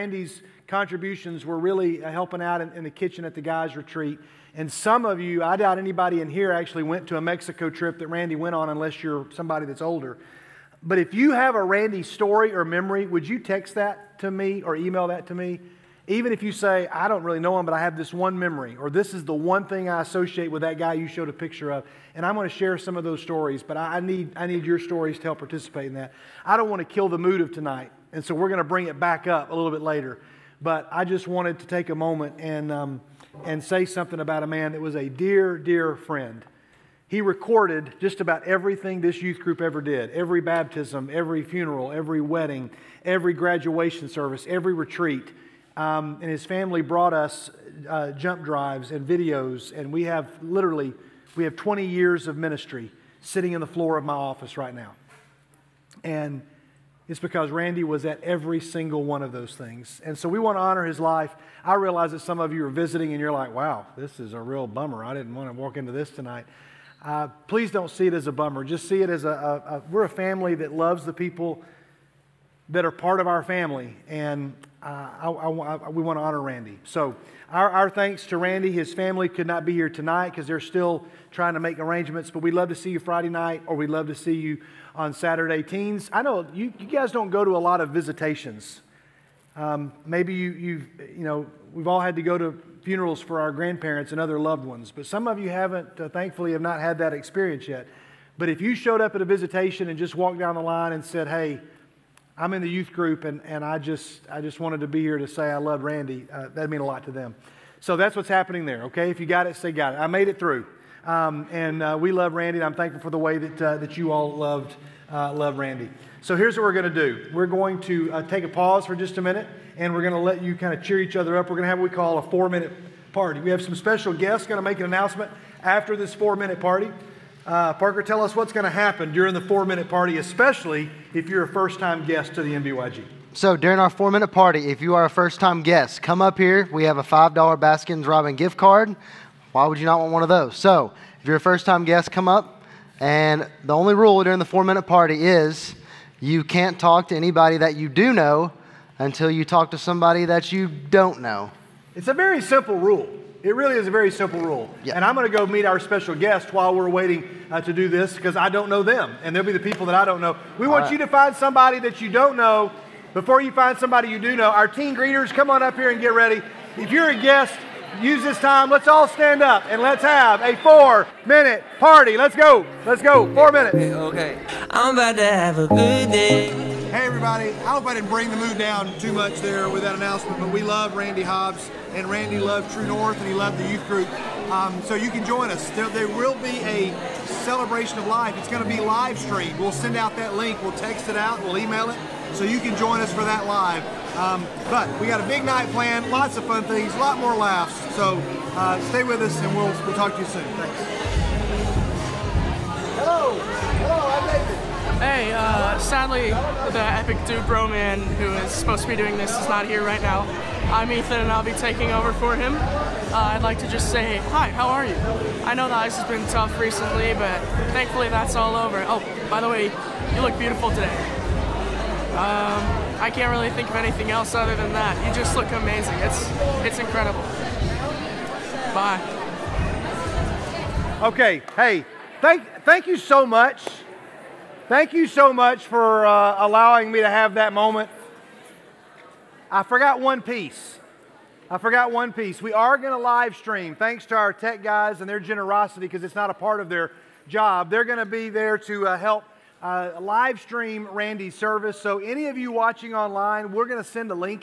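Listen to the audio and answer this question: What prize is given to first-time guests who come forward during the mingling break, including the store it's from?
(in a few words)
$5 Baskin Robbins gift card.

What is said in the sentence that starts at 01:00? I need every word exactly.
And so we want to honor his life.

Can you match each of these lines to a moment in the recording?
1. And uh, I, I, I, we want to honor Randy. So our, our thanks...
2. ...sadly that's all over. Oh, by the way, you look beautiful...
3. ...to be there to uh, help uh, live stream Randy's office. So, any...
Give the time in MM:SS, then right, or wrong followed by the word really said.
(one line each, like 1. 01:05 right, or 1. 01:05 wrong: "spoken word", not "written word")
1. 01:14 right
2. 03:37 wrong: "thankfully", not "sadly"
3. 04:07 wrong: "service", not "office".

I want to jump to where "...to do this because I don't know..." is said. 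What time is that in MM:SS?
02:37.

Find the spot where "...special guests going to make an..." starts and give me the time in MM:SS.
02:03.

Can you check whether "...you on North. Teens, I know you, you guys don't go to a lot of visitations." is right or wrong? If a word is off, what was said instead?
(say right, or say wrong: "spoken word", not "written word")
wrong: "Saturday", not "North".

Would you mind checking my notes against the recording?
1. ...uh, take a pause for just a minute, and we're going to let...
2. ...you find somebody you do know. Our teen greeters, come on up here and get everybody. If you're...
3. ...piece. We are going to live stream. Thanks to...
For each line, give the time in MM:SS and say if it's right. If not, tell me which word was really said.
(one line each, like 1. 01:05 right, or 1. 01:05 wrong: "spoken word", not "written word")
1. 01:58 right
2. 02:43 wrong: "ready", not "everybody"
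3. 04:02 right.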